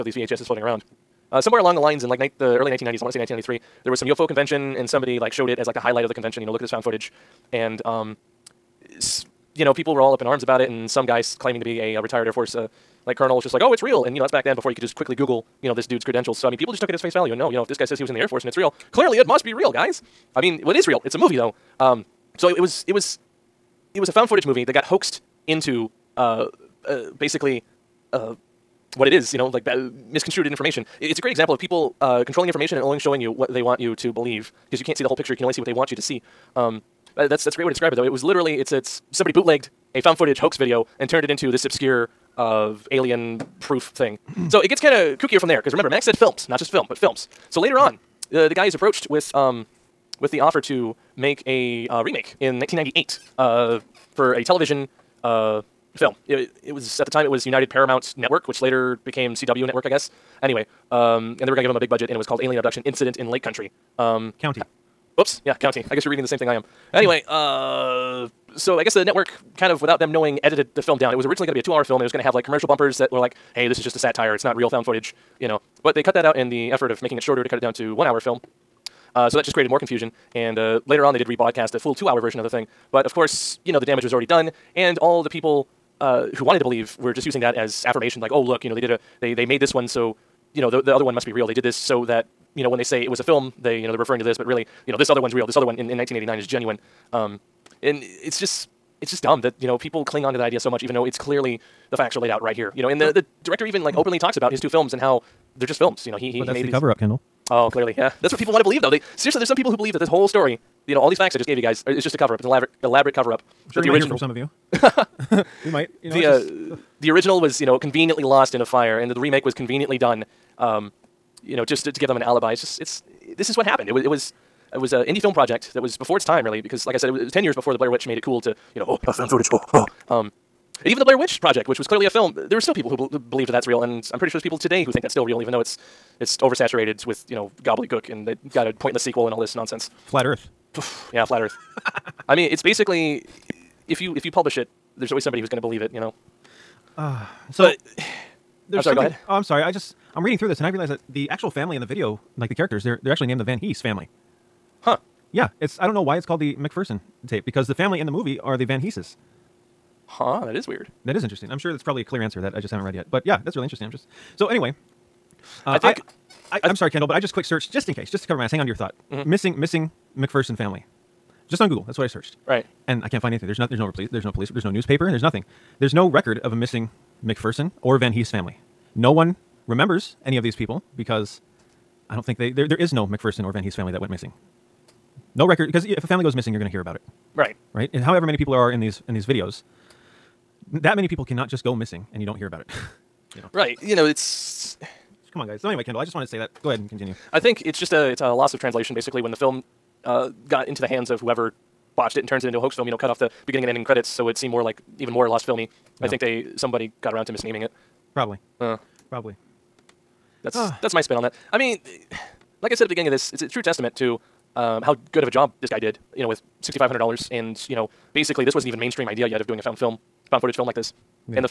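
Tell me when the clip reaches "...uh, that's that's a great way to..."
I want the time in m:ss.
0:37.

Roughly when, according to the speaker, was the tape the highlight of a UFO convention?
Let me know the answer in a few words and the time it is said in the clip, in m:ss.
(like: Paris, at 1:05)
1993, at 0:03.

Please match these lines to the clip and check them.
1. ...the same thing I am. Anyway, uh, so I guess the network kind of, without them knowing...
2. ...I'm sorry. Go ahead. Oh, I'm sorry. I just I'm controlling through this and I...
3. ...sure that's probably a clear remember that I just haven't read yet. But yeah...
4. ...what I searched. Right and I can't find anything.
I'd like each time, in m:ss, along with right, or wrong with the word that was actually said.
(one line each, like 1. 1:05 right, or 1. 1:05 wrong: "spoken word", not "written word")
1. 1:06 right
2. 2:28 wrong: "reading", not "controlling"
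3. 2:41 wrong: "answer", not "remember"
4. 2:51 right.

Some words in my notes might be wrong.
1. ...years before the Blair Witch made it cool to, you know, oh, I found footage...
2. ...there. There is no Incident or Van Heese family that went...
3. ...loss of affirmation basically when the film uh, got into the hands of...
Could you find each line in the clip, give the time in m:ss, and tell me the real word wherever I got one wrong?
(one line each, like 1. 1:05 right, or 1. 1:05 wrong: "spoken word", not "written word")
1. 2:07 right
2. 3:02 wrong: "McPherson", not "Incident"
3. 3:18 wrong: "translation", not "affirmation".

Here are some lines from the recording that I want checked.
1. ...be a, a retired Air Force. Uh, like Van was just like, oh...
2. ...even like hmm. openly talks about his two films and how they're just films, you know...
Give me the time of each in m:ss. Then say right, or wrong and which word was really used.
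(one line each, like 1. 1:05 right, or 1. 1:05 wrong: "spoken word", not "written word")
1. 0:11 wrong: "Colonel", not "Van"
2. 1:43 right.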